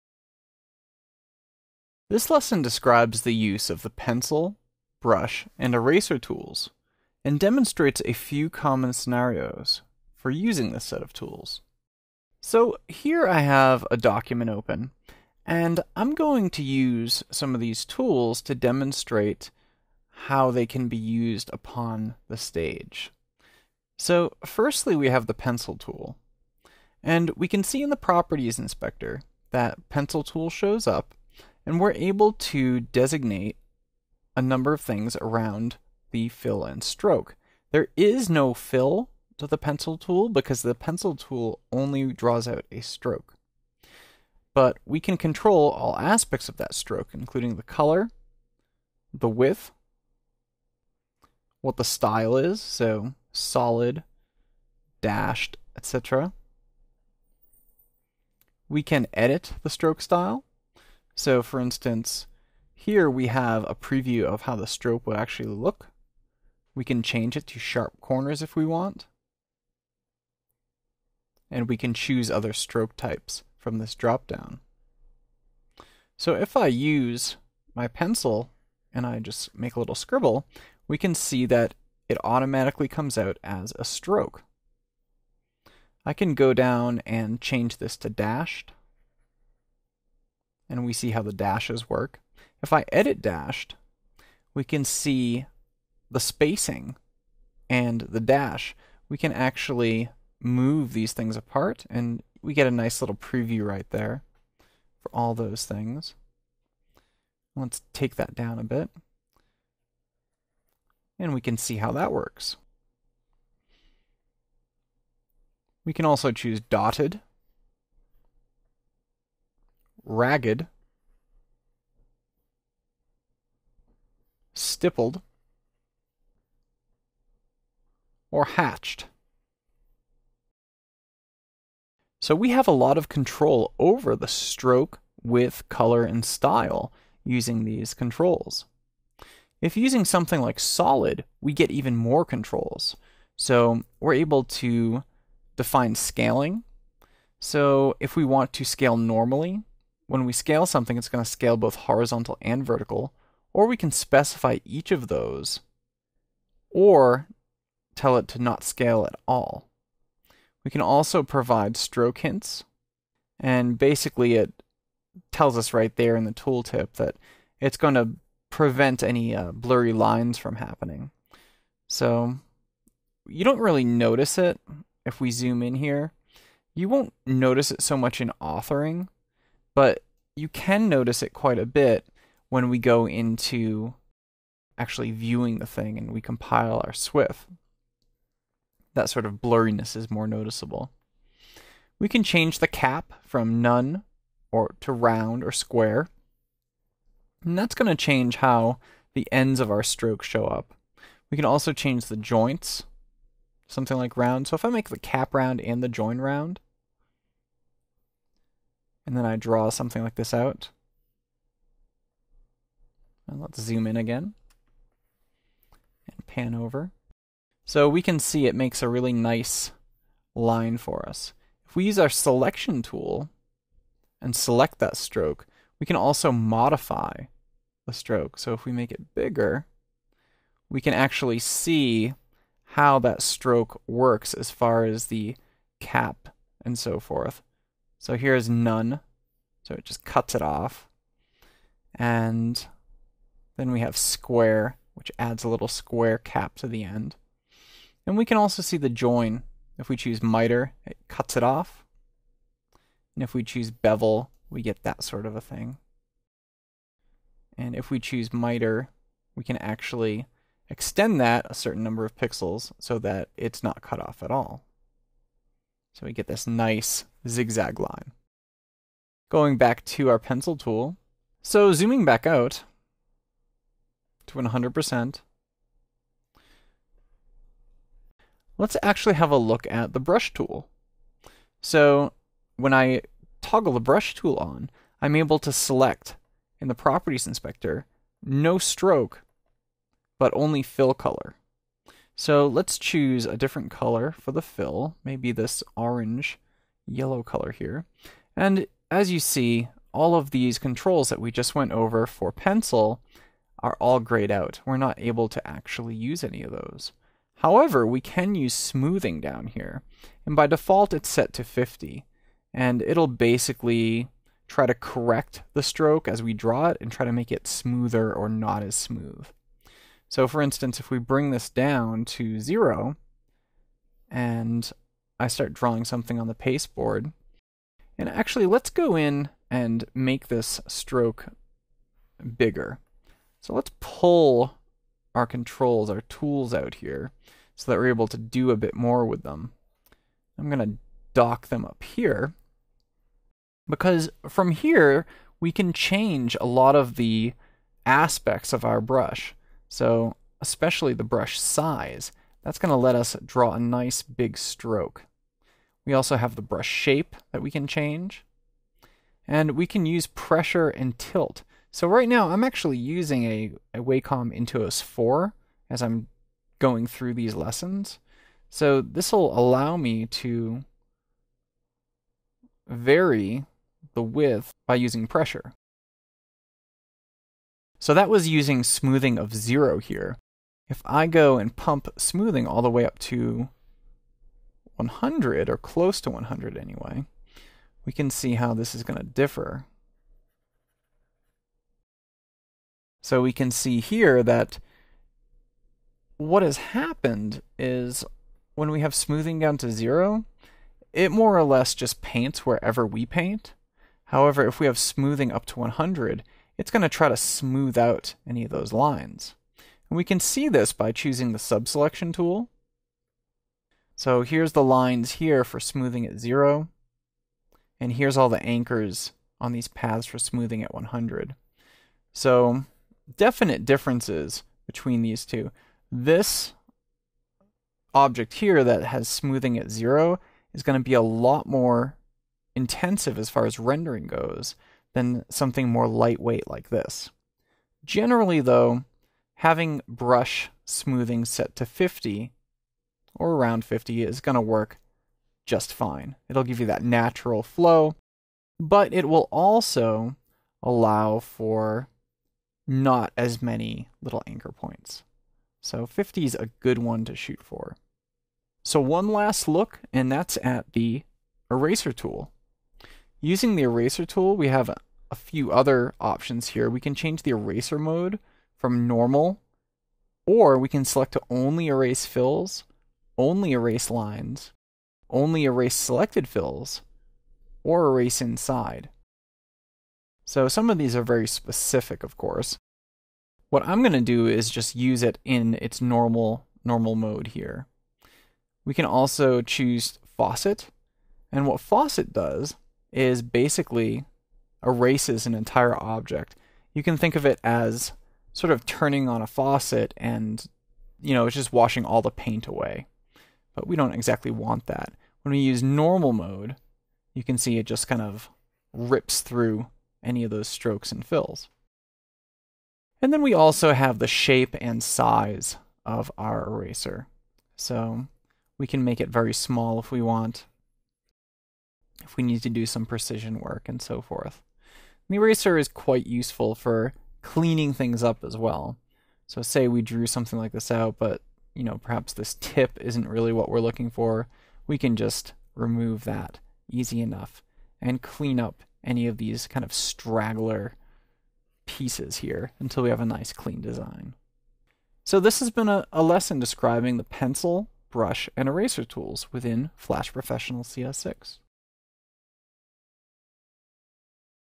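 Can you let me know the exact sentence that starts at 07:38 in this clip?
So one last look, and that's at the eraser tool.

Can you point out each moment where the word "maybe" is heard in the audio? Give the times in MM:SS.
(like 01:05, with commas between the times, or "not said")
04:55.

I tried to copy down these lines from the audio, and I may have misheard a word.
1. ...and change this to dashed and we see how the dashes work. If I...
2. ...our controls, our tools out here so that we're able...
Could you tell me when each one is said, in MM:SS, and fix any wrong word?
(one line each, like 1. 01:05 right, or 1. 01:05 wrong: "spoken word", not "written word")
1. 01:27 right
2. 05:35 right.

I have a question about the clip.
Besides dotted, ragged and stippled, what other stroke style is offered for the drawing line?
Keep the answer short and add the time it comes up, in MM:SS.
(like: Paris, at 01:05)
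Hatched, at 02:08.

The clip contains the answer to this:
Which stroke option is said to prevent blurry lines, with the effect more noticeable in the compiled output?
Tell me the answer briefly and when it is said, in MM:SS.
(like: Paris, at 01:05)
Stroke hints, at 02:41.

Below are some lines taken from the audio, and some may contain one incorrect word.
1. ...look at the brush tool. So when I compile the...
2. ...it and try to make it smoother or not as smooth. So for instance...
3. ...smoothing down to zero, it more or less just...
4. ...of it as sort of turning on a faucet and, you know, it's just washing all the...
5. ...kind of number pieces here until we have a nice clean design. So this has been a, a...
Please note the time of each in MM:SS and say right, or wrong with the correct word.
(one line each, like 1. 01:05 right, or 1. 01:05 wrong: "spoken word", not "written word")
1. 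04:39 wrong: "toggle", not "compile"
2. 05:16 right
3. 06:38 right
4. 08:17 right
5. 08:59 wrong: "straggler", not "number".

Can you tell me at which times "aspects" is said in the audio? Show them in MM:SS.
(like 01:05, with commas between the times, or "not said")
00:45, 05:47.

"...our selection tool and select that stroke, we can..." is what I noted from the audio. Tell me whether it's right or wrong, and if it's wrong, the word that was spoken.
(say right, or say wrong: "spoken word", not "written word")
right.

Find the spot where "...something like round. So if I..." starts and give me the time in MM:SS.
03:23.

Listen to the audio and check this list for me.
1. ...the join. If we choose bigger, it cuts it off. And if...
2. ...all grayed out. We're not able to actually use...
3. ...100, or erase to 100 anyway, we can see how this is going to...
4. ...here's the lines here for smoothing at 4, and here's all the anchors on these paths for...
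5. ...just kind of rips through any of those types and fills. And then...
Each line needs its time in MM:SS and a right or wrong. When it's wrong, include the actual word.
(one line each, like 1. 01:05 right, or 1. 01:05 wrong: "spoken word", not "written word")
1. 04:08 wrong: "miter", not "bigger"
2. 05:03 right
3. 06:24 wrong: "close", not "erase"
4. 06:54 wrong: "0", not "4"
5. 08:27 wrong: "strokes", not "types".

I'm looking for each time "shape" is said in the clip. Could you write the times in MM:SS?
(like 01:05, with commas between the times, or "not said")
05:56, 08:34.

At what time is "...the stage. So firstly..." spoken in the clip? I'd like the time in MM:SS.
00:22.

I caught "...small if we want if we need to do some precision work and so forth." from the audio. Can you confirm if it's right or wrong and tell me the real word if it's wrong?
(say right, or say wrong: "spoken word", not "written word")
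right.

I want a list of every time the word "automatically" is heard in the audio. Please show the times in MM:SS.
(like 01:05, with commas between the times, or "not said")
01:22.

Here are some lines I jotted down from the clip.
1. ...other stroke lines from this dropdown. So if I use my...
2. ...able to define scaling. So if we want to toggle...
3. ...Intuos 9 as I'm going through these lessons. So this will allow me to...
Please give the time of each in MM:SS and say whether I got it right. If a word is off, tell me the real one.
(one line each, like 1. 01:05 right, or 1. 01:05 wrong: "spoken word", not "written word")
1. 01:12 wrong: "types", not "lines"
2. 02:24 wrong: "scale", not "toggle"
3. 06:04 wrong: "4", not "9".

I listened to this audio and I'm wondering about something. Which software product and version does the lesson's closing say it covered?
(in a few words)
Flash Professional CS6.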